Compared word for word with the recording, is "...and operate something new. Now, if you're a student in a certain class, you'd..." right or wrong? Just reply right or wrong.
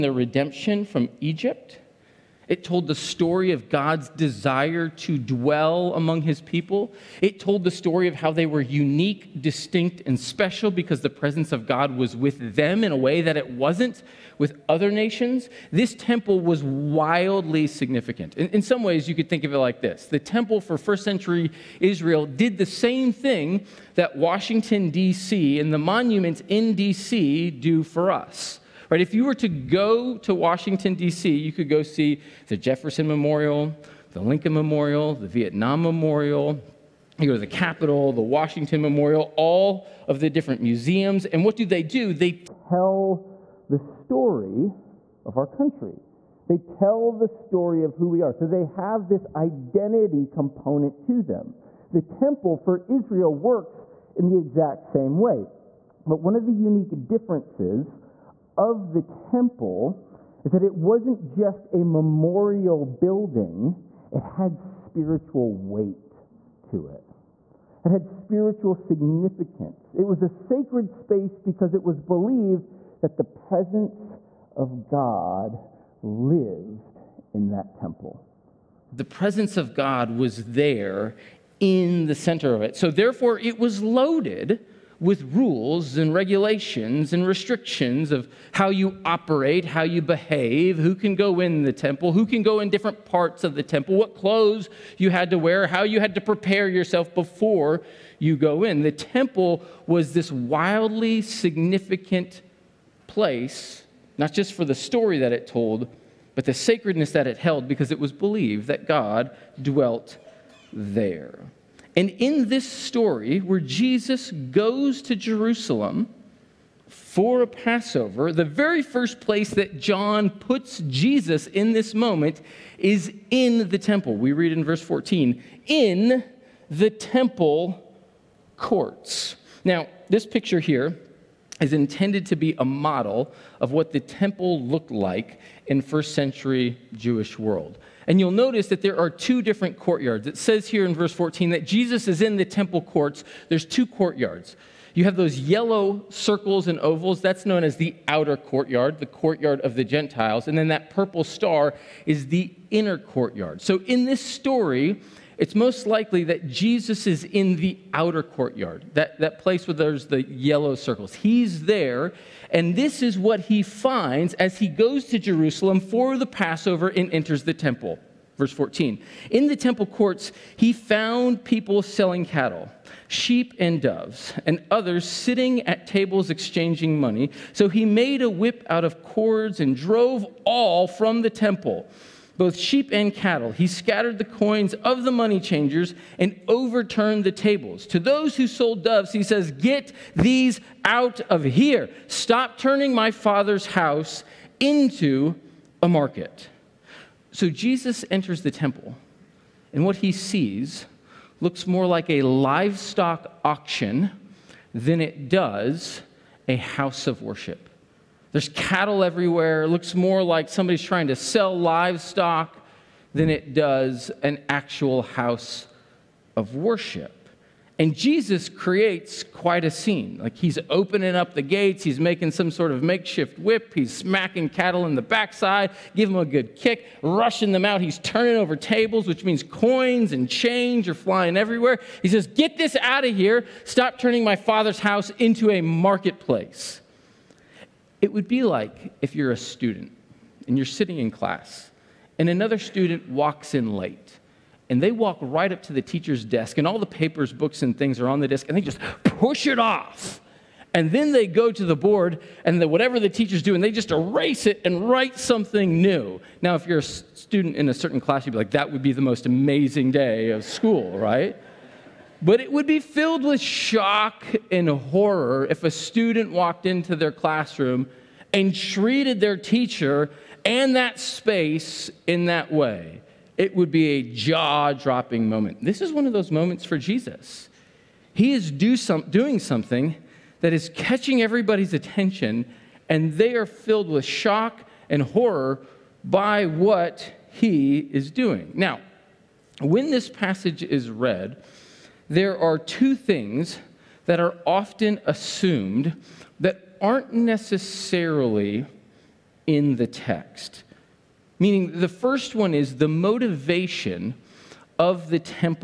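wrong.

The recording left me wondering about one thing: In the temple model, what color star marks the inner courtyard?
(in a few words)
Purple.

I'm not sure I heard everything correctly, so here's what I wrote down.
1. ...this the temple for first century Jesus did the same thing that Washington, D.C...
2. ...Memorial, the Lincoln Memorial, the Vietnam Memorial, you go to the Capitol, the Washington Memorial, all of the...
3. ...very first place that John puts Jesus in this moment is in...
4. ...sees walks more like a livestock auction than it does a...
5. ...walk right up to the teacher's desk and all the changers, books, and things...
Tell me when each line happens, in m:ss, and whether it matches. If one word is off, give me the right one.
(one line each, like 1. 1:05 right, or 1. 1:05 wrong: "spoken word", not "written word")
1. 0:19 wrong: "Israel", not "Jesus"
2. 0:33 right
3. 1:58 right
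4. 3:20 wrong: "looks", not "walks"
5. 4:04 wrong: "papers", not "changers".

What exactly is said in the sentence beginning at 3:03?
He scattered the coins of the money changers and overturned the tables.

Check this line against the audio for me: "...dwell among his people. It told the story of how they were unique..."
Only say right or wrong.
right.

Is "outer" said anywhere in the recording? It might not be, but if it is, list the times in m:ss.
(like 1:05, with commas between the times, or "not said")
2:28, 2:37.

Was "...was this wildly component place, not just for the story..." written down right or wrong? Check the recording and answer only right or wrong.
wrong.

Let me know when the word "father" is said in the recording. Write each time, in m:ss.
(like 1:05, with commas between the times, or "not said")
3:13, 3:54.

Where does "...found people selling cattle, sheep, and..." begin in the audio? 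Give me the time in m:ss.
2:50.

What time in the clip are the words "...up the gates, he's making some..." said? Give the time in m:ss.
3:41.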